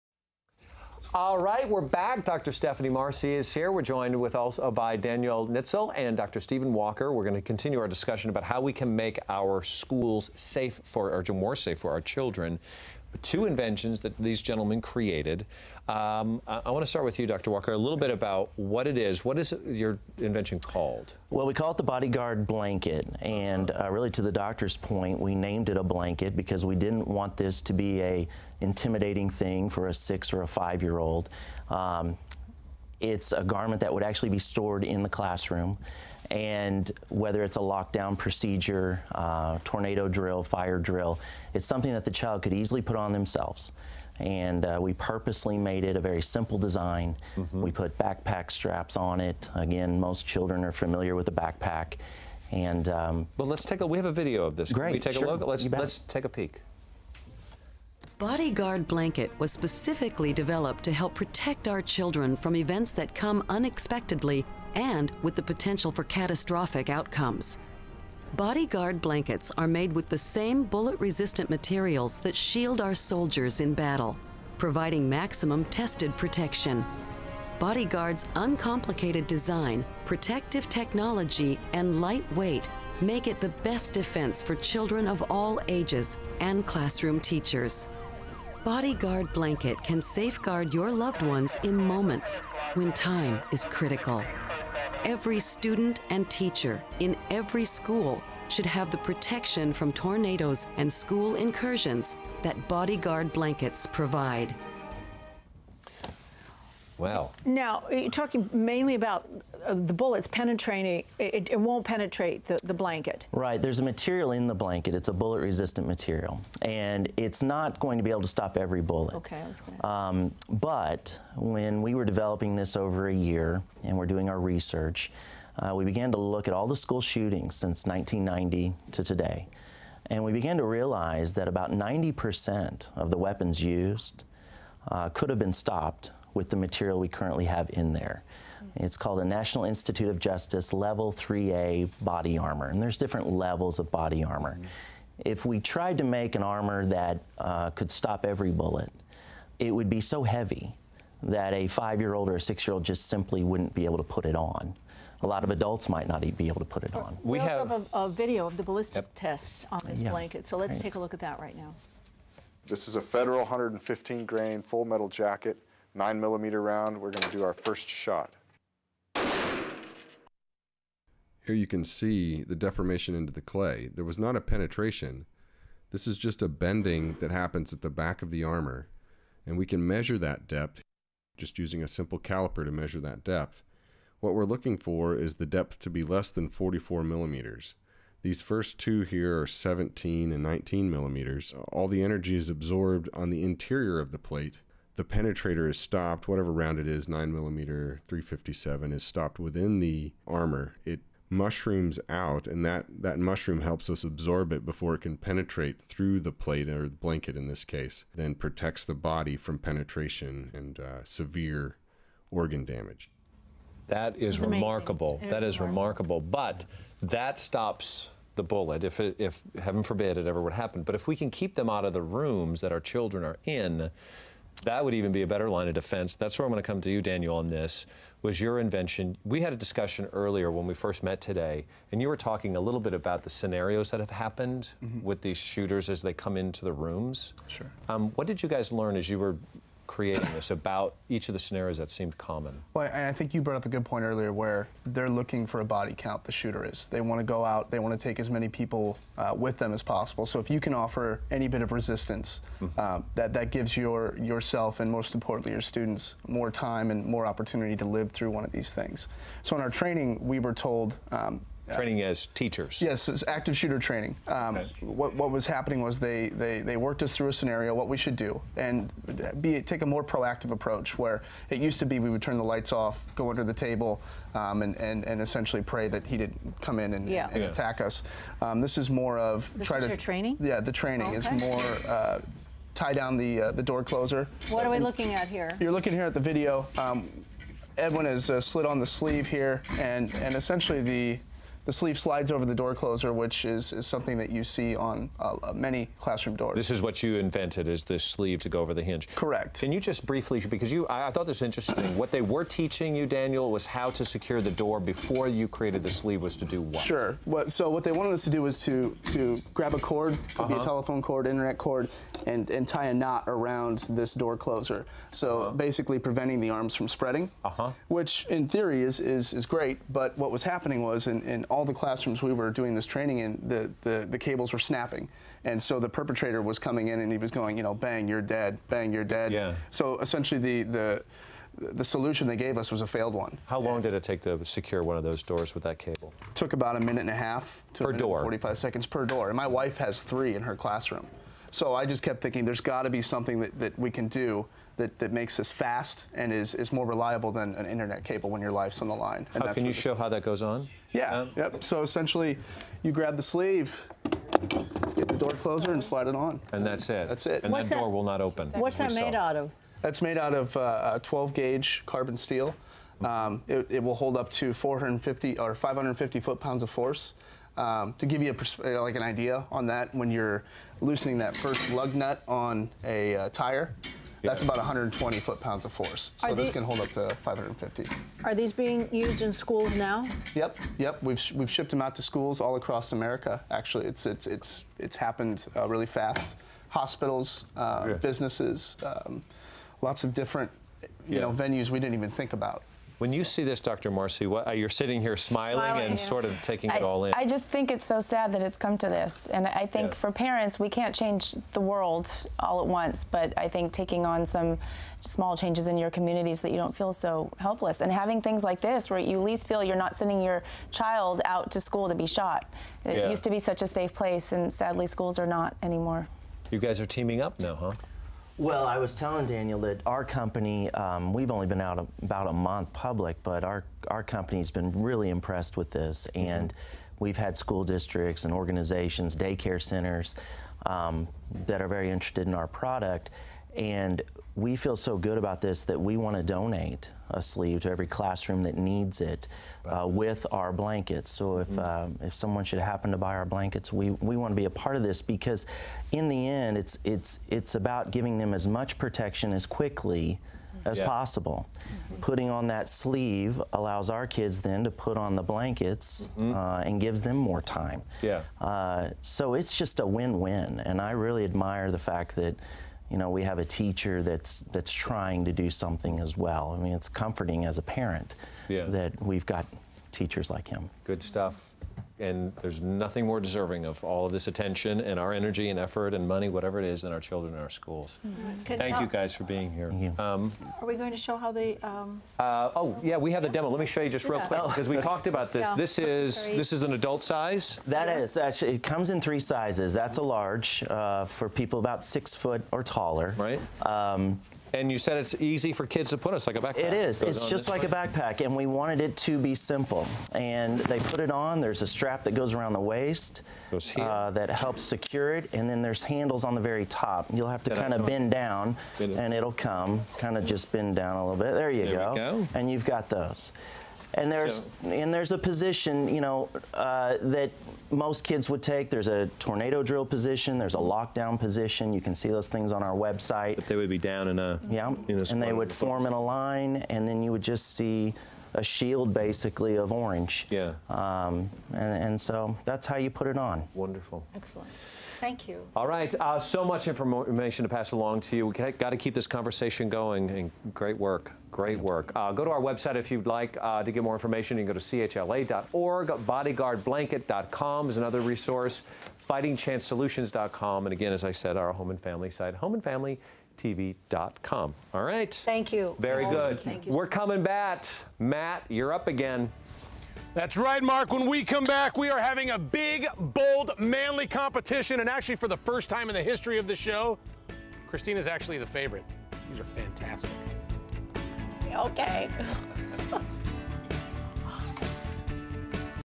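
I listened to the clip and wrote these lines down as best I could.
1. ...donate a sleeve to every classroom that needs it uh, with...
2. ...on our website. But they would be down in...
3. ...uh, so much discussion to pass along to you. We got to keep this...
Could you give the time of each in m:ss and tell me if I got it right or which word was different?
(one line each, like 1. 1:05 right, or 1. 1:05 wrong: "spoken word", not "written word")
1. 7:16 right
2. 8:42 right
3. 8:55 wrong: "information", not "discussion".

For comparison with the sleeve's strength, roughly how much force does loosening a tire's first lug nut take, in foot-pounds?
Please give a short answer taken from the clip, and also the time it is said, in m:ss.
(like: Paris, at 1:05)
120, at 6:14.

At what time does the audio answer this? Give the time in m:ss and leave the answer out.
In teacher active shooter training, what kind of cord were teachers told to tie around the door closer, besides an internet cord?
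5:10.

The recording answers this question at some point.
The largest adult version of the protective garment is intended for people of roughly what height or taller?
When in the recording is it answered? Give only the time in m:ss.
8:11.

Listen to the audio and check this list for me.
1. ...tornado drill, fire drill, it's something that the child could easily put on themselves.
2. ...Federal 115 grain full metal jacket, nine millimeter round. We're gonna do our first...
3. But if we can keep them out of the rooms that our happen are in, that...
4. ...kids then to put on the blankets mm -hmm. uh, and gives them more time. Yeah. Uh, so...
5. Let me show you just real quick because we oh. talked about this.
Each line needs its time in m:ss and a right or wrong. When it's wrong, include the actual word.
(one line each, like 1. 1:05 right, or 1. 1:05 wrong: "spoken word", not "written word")
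1. 0:39 right
2. 2:43 right
3. 3:40 wrong: "children", not "happen"
4. 7:34 right
5. 8:03 right.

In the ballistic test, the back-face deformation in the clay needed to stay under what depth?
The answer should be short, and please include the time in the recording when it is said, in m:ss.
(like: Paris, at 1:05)
44 millimeters, at 3:06.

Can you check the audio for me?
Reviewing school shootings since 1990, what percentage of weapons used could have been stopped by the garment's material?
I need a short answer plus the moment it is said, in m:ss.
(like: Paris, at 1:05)
90%, at 2:11.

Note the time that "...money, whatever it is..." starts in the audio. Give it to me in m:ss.
7:56.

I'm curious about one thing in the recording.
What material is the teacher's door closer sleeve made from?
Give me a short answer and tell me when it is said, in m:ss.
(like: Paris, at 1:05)
12 gauge carbon steel, at 6:01.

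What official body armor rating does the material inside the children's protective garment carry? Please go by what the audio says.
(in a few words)
Level 3A.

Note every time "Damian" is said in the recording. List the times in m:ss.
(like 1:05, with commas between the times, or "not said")
not said.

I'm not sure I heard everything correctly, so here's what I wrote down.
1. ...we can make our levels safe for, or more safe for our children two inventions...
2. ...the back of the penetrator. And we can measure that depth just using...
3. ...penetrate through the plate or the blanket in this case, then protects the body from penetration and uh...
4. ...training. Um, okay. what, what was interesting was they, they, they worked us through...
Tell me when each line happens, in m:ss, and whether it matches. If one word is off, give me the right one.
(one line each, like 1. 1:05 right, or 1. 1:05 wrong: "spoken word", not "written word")
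1. 0:08 wrong: "schools", not "levels"
2. 2:57 wrong: "armor", not "penetrator"
3. 3:25 right
4. 4:23 wrong: "happening", not "interesting".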